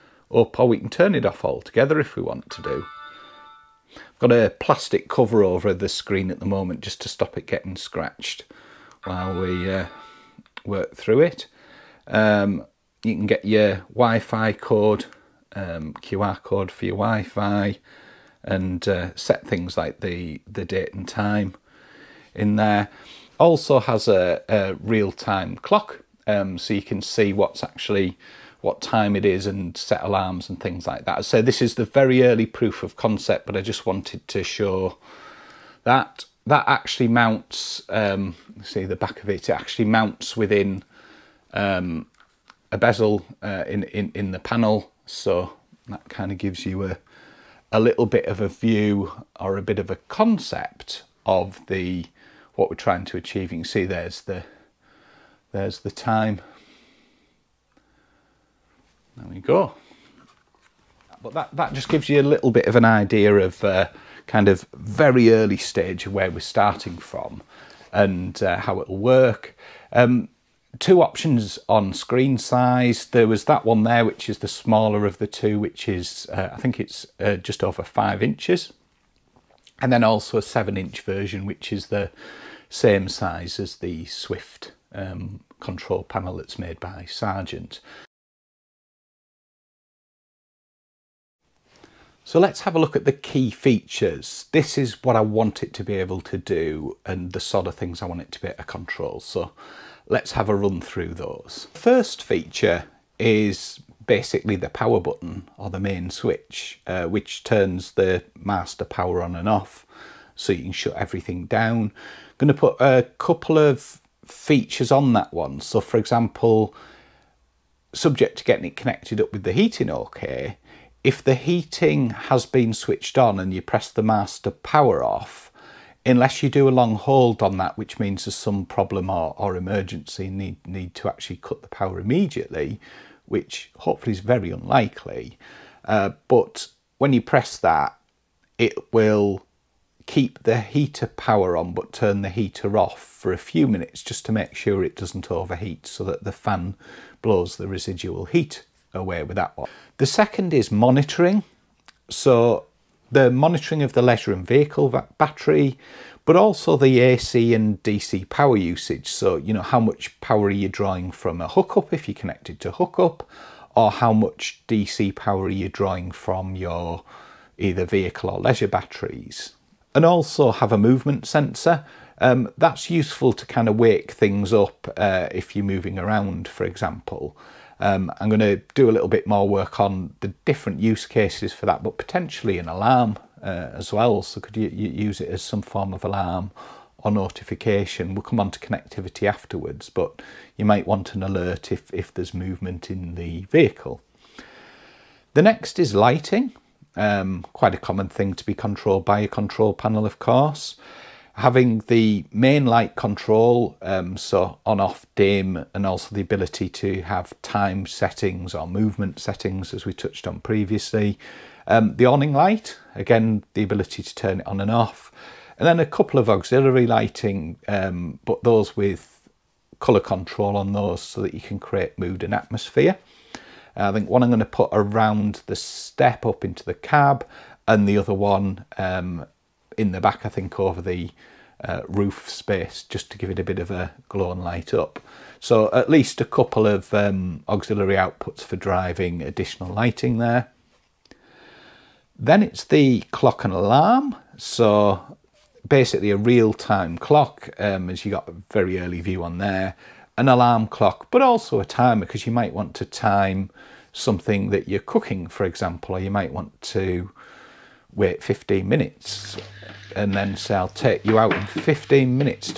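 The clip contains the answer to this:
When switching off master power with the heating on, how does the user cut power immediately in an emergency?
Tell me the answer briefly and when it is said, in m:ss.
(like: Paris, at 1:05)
long hold, at 2:06.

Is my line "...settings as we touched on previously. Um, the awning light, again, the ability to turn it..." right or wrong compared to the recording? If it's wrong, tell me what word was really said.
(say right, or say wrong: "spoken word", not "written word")
right.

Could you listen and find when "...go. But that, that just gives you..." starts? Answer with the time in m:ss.
0:59.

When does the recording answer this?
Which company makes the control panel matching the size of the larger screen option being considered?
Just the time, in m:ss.
1:27.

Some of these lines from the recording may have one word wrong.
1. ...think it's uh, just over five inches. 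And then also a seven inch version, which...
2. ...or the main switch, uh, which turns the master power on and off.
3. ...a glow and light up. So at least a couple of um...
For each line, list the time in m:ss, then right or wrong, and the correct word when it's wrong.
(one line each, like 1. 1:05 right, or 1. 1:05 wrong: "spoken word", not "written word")
1. 1:16 right
2. 1:45 right
3. 3:53 right.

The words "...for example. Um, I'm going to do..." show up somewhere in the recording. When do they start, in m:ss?
2:56.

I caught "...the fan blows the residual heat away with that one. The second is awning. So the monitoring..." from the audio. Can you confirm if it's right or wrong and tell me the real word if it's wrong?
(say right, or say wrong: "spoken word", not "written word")
wrong: "monitoring", not "awning".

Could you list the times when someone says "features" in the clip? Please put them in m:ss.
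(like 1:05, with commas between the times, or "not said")
1:33, 1:42, 1:54.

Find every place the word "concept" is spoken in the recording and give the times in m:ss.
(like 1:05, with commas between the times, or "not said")
0:32, 0:49.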